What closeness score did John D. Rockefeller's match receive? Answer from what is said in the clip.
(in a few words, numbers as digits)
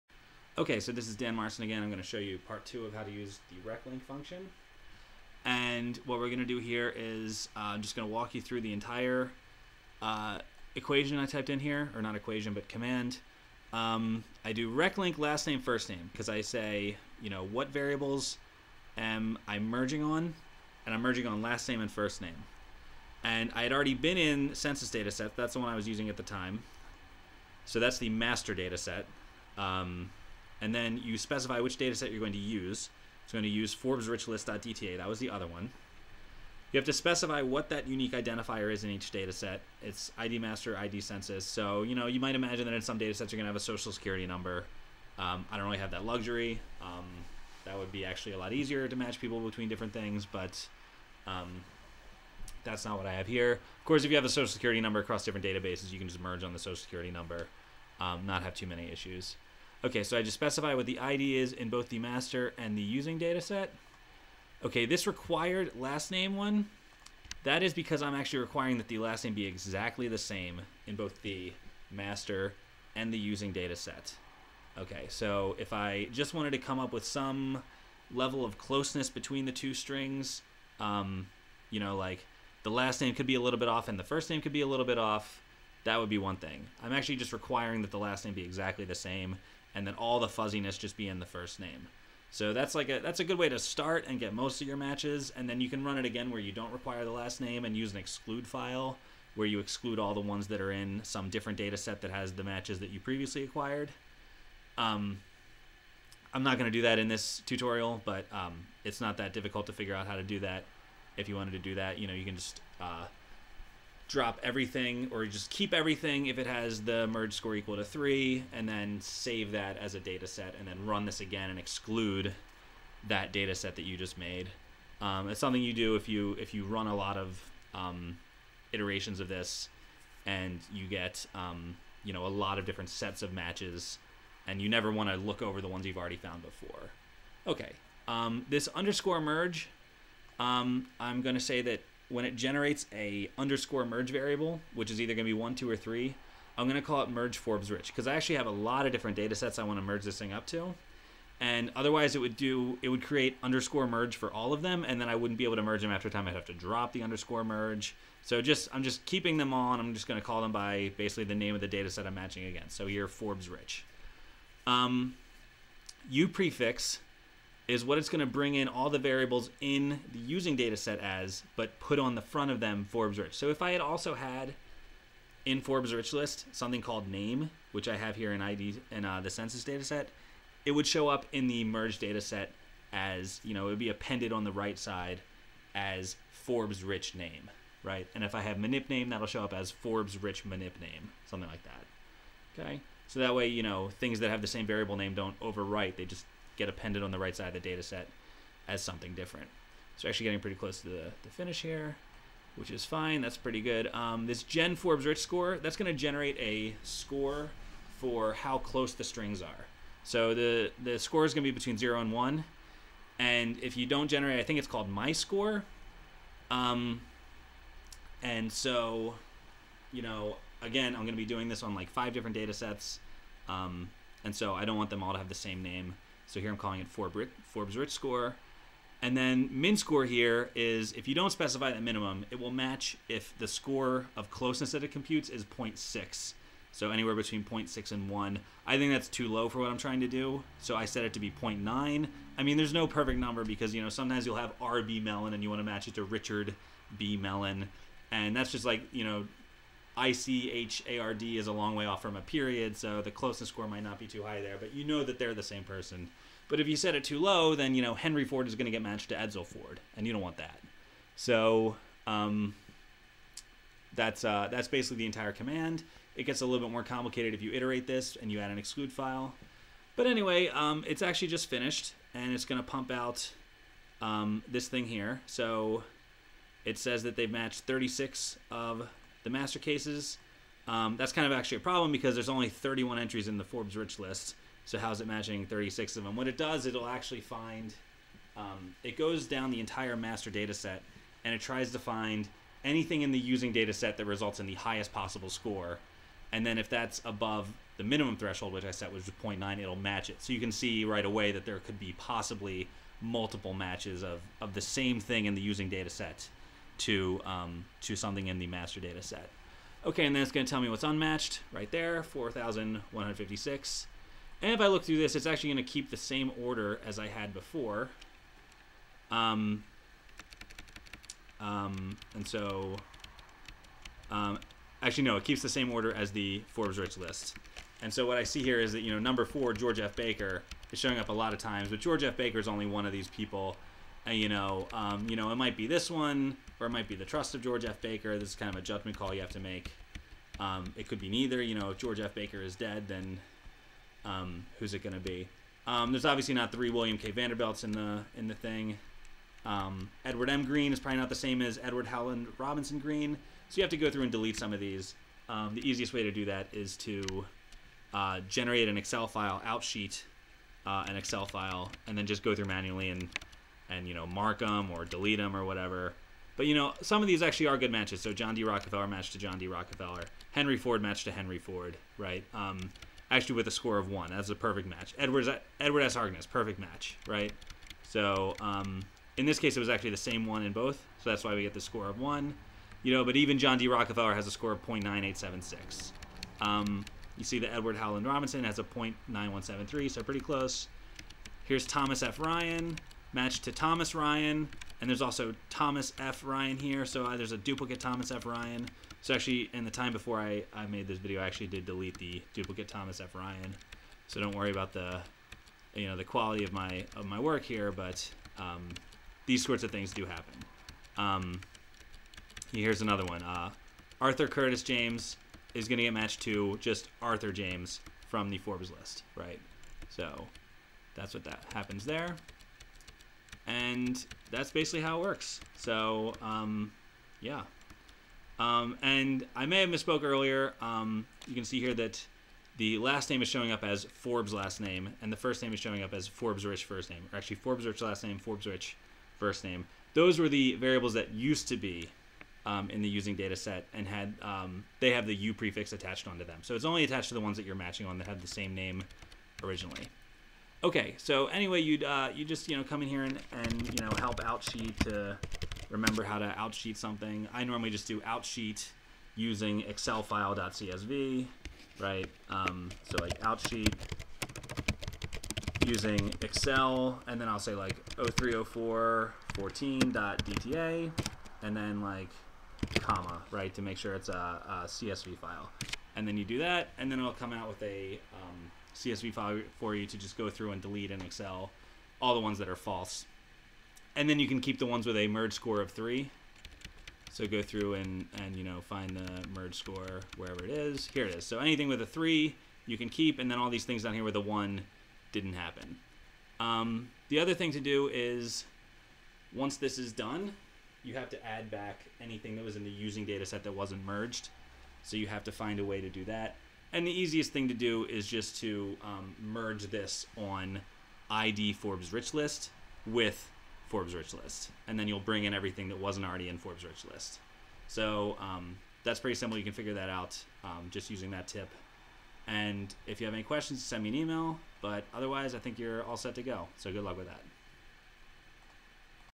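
0.9876.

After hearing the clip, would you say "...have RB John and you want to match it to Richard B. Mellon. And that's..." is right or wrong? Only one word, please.
wrong.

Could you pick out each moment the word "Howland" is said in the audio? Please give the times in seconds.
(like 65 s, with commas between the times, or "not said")
351 s, 387 s.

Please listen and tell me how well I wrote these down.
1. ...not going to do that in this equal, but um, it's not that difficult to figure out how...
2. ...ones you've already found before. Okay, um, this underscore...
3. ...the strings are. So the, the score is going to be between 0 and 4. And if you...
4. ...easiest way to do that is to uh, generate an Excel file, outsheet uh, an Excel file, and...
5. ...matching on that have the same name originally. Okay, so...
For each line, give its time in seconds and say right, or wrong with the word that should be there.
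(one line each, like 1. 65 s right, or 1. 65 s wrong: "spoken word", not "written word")
1. 106 s wrong: "tutorial", not "equal"
2. 135 s right
3. 208 s wrong: "1", not "4"
4. 355 s right
5. 447 s right.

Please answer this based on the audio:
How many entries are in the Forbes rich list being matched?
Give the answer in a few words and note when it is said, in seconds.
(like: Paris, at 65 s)
31, at 282 s.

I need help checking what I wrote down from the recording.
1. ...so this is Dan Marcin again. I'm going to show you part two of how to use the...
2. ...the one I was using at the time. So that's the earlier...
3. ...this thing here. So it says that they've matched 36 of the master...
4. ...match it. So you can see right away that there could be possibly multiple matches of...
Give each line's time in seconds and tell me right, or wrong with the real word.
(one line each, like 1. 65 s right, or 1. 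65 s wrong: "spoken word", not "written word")
1. 0 s right
2. 25 s wrong: "master", not "earlier"
3. 274 s right
4. 299 s right.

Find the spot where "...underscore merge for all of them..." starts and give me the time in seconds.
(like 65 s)
153 s.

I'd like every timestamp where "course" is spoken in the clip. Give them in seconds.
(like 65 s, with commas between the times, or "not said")
53 s.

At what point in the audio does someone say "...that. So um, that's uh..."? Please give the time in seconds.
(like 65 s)
260 s.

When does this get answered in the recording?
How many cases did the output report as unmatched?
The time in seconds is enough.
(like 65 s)
312 s.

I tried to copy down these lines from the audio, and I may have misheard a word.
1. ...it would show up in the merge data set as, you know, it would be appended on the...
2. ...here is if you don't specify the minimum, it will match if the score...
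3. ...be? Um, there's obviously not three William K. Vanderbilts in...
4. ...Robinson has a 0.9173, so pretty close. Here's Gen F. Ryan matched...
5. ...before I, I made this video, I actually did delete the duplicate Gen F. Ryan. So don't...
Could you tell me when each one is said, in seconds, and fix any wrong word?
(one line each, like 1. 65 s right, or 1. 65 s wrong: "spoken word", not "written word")
1. 180 s right
2. 230 s right
3. 344 s right
4. 388 s wrong: "Thomas", not "Gen"
5. 399 s wrong: "Thomas", not "Gen".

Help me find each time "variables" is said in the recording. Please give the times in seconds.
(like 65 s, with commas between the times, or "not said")
17 s, 144 s, 168 s, 194 s, 440 s.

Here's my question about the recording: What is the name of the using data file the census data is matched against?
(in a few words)
Forbes Rich List.dta.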